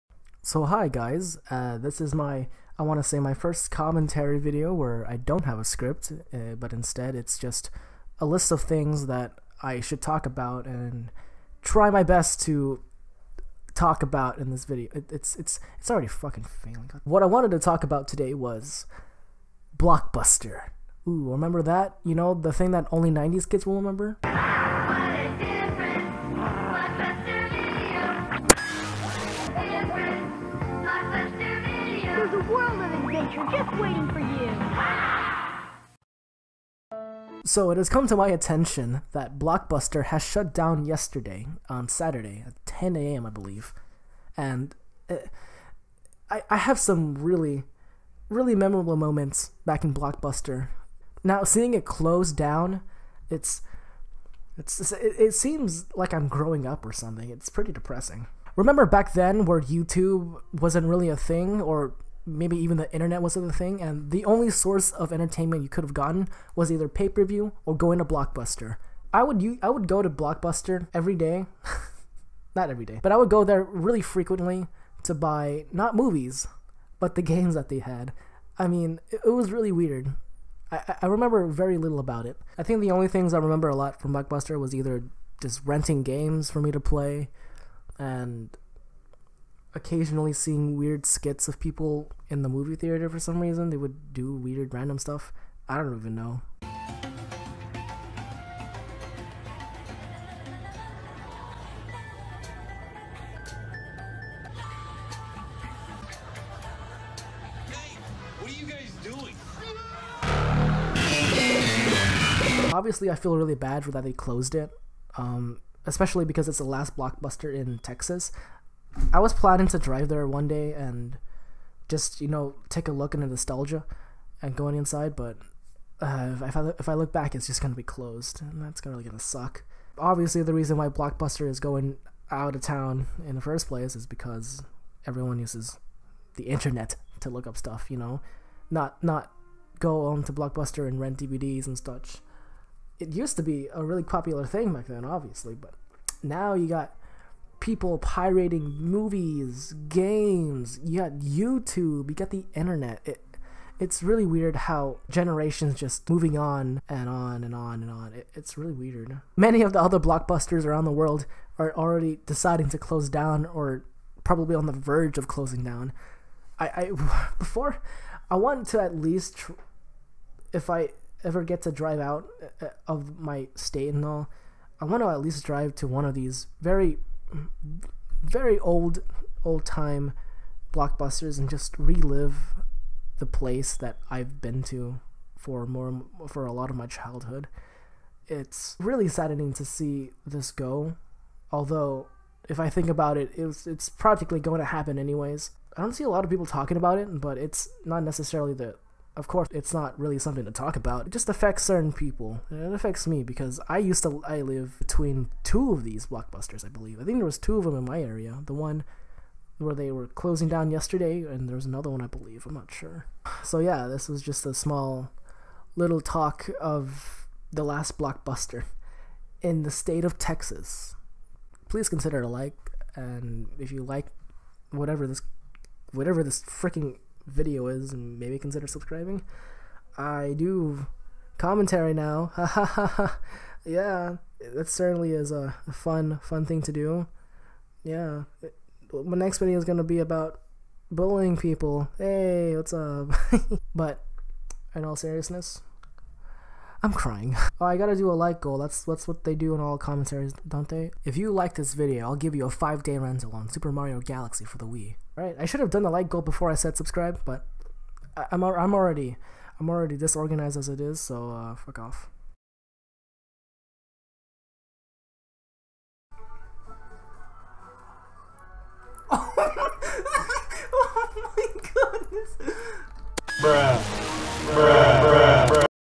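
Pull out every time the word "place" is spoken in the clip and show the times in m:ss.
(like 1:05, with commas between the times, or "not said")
2:13, 3:03.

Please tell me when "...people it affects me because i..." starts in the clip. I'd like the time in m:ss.
3:21.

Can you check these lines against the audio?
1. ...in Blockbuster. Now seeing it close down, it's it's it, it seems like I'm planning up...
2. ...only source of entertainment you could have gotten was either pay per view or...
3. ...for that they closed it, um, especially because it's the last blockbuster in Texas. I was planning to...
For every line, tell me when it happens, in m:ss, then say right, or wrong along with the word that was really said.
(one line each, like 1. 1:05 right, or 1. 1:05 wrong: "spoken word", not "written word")
1. 0:49 wrong: "growing", not "planning"
2. 1:04 right
3. 1:53 right.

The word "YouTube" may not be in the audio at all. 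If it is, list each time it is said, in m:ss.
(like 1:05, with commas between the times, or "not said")
0:59, 2:31.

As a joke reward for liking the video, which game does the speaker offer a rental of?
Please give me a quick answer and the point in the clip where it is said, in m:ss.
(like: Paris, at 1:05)
Super Mario Galaxy, at 4:13.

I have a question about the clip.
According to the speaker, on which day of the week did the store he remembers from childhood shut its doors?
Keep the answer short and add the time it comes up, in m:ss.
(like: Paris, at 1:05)
Saturday, at 0:41.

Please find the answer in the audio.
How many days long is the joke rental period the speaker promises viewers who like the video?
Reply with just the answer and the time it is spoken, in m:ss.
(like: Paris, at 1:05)
5, at 4:12.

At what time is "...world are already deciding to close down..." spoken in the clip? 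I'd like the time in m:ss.
2:40.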